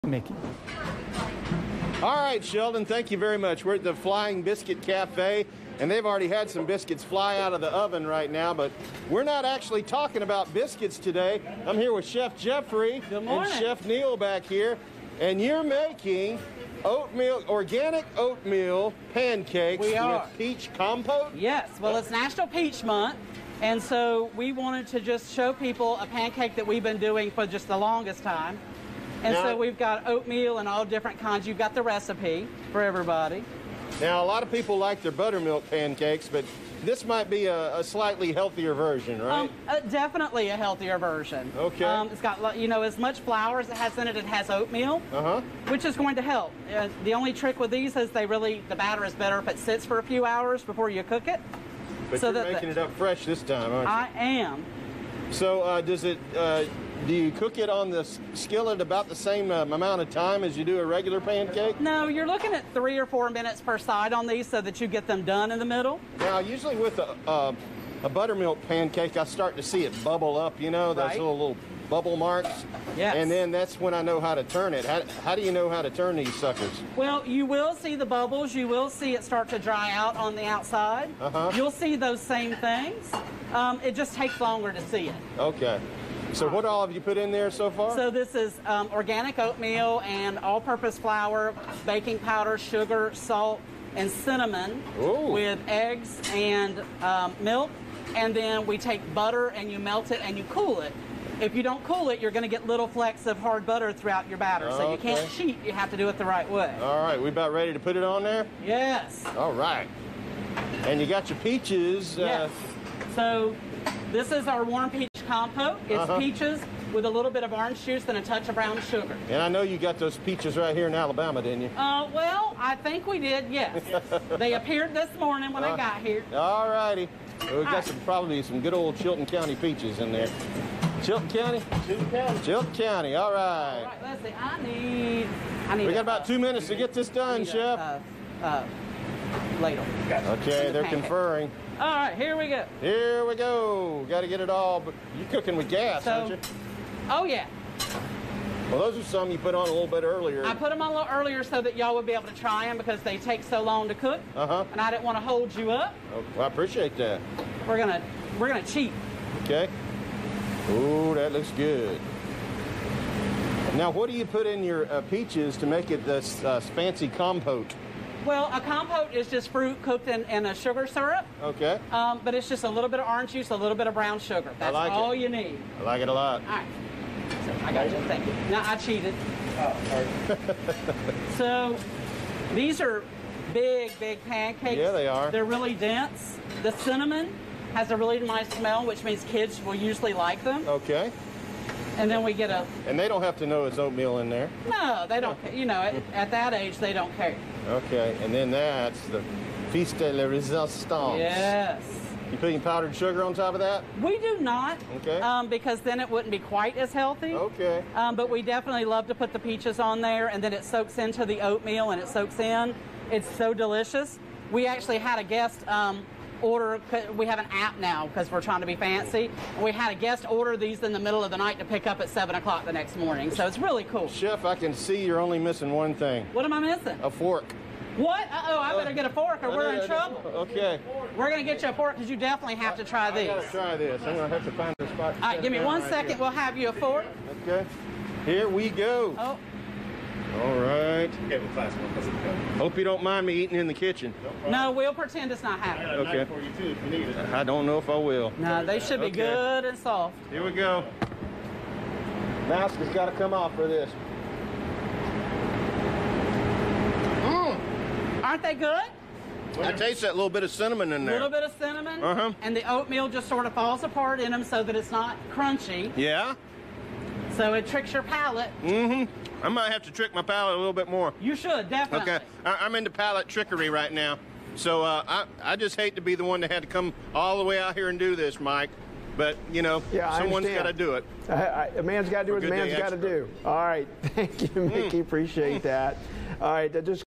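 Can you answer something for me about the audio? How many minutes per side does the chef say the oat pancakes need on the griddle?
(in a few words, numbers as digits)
3 or 4 minutes.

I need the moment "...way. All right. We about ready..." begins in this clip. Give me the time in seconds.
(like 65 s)
106 s.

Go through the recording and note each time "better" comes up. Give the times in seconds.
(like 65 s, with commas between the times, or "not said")
49 s, 228 s.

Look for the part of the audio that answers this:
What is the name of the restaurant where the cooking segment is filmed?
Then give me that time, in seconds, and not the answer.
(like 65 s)
3 s.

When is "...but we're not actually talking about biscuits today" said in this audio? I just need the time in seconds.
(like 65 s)
8 s.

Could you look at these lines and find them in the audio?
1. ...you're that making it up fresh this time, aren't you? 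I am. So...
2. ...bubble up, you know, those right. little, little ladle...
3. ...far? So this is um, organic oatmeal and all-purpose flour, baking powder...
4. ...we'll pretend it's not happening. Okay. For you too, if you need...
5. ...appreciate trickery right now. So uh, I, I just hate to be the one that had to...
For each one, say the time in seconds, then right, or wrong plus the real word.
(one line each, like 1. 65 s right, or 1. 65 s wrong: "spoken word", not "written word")
1. 52 s right
2. 70 s wrong: "bubble", not "ladle"
3. 87 s right
4. 244 s right
5. 272 s wrong: "palate", not "appreciate".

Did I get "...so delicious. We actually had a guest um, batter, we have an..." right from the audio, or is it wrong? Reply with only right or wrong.
wrong.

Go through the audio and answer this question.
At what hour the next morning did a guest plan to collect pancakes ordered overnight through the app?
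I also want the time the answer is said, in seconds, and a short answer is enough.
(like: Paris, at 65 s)
7 o'clock, at 222 s.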